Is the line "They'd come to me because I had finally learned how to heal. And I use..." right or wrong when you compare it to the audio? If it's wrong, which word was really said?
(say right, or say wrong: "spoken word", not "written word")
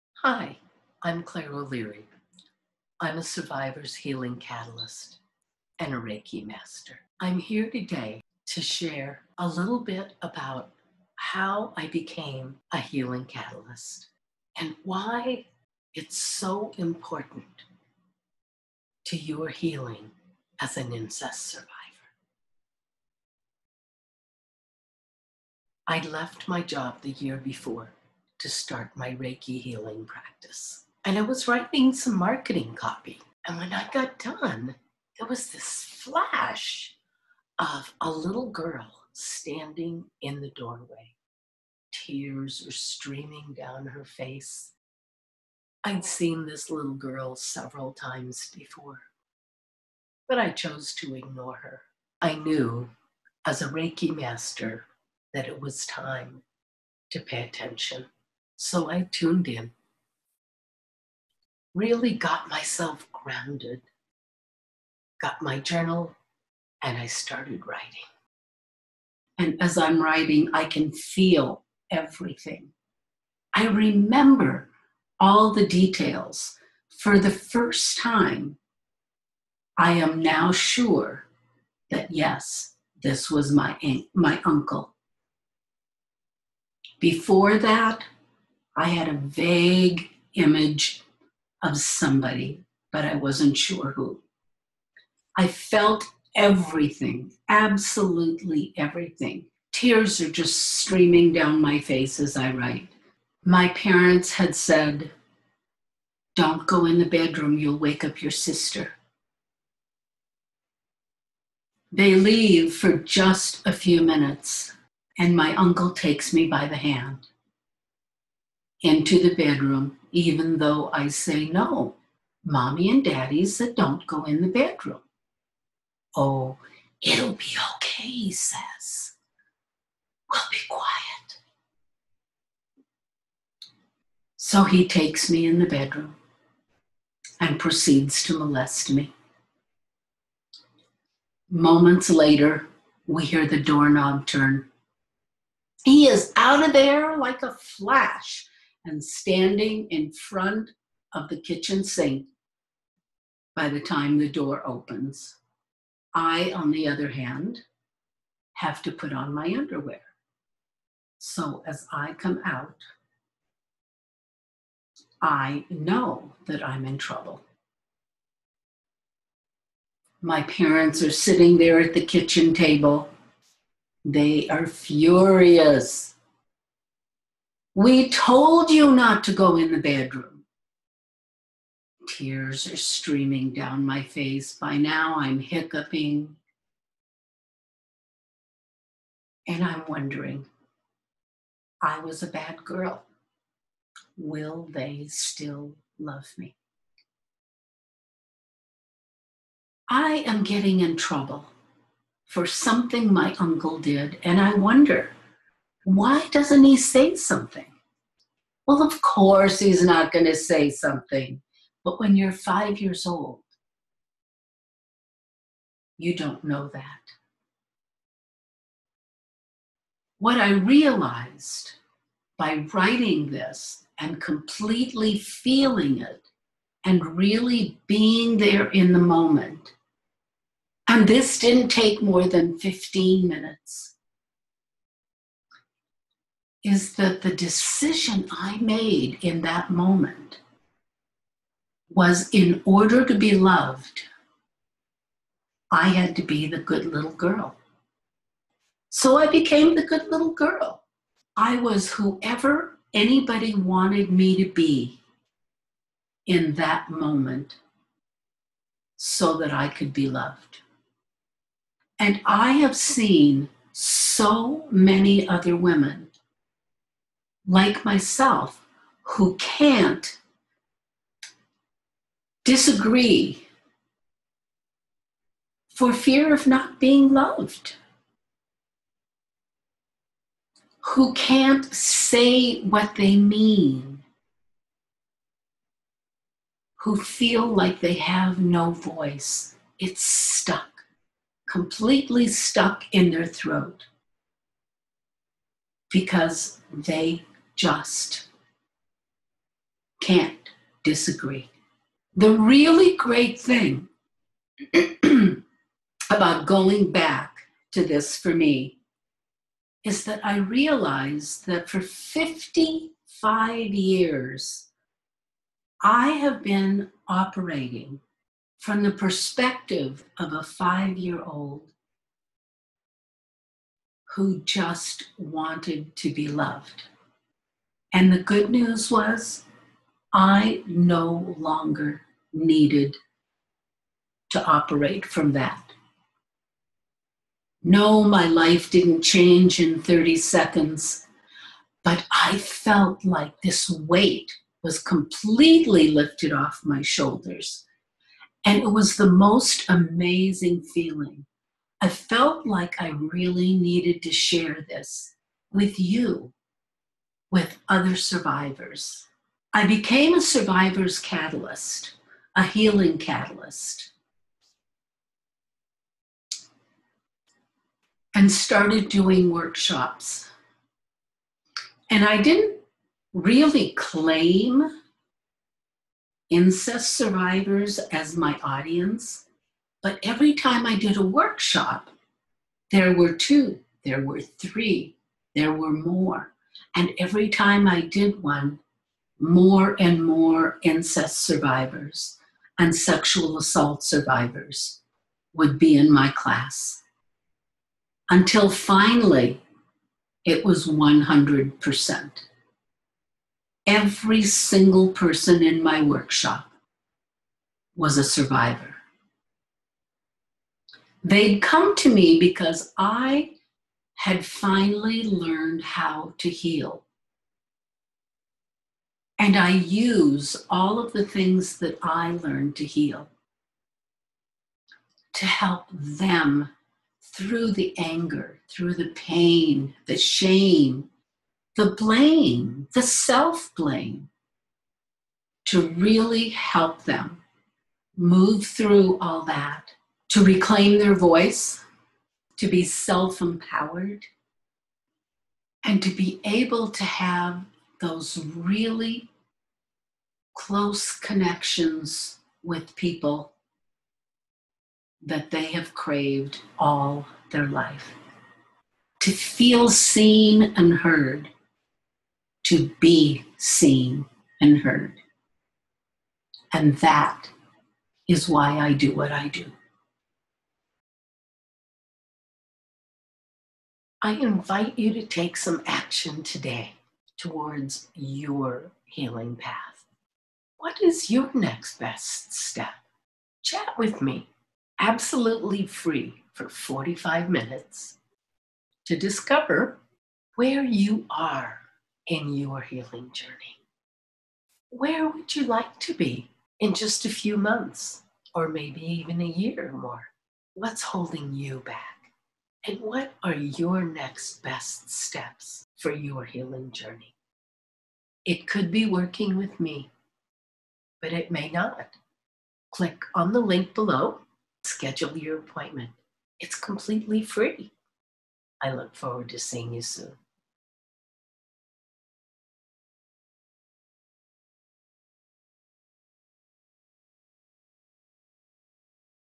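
right.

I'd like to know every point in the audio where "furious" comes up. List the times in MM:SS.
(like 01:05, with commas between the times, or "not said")
02:54.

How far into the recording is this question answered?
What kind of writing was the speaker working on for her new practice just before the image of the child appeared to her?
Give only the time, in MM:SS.
00:32.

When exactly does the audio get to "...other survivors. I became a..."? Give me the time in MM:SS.
05:57.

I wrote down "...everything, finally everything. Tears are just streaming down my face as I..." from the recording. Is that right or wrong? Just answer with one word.
wrong.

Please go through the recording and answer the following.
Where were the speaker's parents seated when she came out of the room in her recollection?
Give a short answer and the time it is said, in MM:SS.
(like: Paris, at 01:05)
at the kitchen table, at 02:52.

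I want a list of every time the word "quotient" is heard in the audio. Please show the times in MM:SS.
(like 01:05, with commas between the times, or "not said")
not said.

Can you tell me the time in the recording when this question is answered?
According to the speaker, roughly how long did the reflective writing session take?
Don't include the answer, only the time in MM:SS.
03:52.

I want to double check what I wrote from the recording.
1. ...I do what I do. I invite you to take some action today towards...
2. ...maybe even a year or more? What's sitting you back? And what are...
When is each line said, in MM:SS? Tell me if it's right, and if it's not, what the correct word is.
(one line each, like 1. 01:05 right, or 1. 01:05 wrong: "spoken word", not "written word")
1. 07:48 right
2. 08:18 wrong: "holding", not "sitting".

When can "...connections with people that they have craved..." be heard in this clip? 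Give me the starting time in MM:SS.
07:30.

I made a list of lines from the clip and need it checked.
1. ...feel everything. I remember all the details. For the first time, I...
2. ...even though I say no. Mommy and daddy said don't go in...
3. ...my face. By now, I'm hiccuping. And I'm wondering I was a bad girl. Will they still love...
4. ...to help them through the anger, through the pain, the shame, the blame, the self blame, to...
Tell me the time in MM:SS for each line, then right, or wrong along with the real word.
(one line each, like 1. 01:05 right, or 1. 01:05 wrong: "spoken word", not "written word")
1. 01:10 right
2. 02:00 right
3. 03:03 right
4. 07:05 right.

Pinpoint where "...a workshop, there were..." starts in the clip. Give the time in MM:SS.
06:20.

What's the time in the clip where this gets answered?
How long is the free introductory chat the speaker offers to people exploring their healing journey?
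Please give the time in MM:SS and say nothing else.
08:06.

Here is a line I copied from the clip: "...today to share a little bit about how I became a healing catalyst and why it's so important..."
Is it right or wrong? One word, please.
right.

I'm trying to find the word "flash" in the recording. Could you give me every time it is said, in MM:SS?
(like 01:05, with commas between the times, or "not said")
00:35, 02:27.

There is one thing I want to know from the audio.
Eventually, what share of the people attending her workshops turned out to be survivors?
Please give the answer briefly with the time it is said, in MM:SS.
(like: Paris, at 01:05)
100%, at 06:40.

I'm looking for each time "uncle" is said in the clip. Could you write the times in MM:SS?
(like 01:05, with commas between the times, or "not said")
01:24, 01:55, 03:23.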